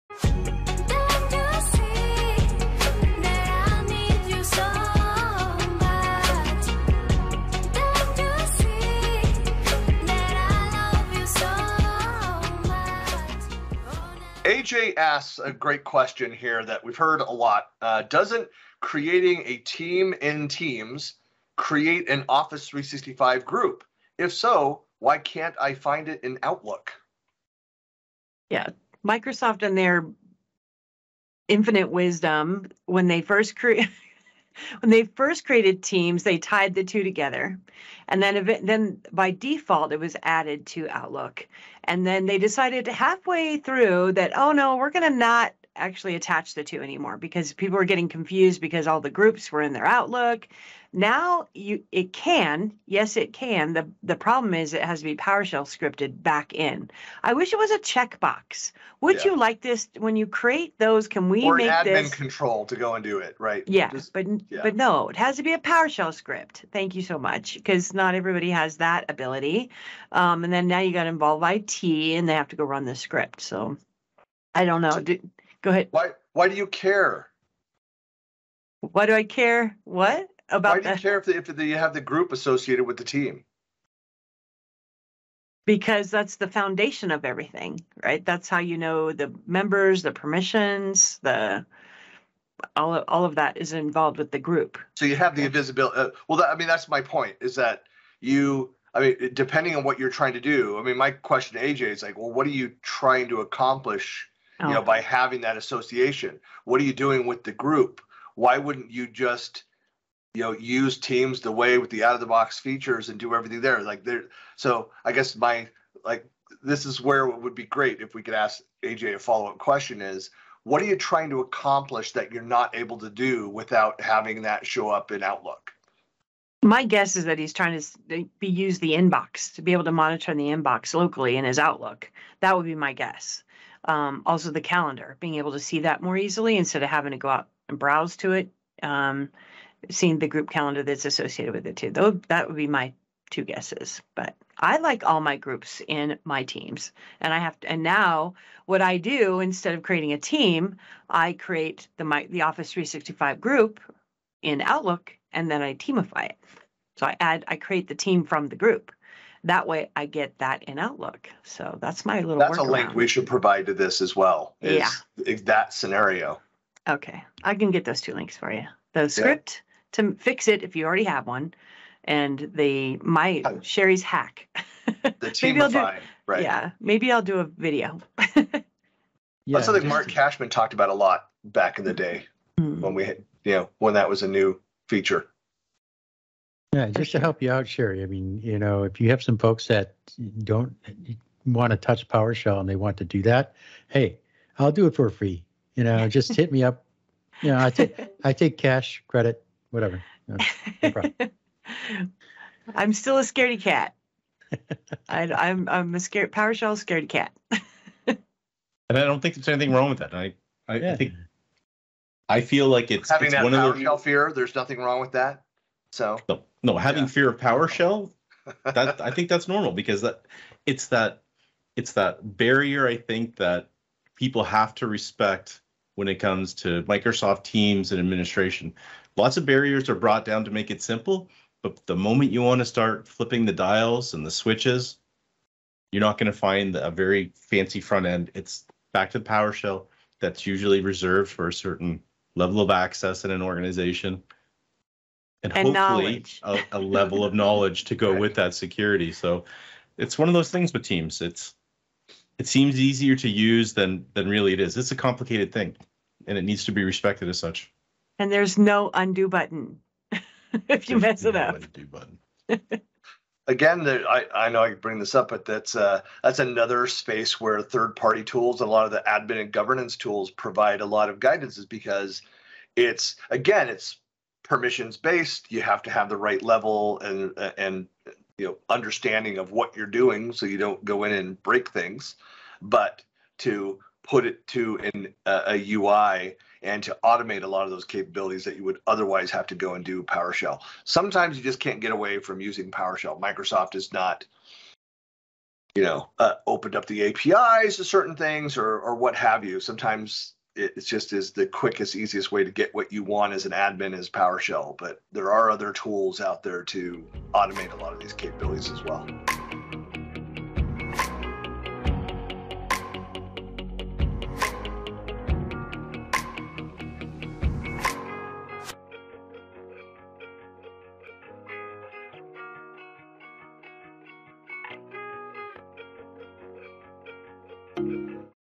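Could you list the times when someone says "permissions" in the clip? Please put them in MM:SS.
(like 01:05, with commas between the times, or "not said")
01:30, 04:34.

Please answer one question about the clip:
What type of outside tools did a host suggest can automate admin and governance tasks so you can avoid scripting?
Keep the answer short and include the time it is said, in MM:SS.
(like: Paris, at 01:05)
Third-party tools, at 04:27.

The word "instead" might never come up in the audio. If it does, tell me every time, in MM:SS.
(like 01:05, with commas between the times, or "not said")
02:16, 02:29.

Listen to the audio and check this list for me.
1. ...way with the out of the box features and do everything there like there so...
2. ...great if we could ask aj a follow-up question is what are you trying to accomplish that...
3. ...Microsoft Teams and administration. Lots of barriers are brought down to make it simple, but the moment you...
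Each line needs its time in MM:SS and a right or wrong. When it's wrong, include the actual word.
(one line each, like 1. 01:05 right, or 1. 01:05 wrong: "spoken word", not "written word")
1. 01:51 right
2. 01:57 right
3. 03:46 right.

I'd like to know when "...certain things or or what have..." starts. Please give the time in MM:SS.
04:57.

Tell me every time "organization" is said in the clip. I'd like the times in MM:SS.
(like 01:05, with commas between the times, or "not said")
04:03.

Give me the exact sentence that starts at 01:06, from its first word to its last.
Thank you so much, because not everybody has that ability.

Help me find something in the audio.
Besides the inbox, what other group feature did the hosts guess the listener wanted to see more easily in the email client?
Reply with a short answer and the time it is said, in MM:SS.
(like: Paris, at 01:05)
The calendar, at 02:14.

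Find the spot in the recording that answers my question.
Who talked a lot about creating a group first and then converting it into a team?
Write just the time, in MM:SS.
02:59.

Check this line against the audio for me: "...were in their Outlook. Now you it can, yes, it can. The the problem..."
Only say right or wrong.
right.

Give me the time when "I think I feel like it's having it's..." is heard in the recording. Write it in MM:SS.
03:30.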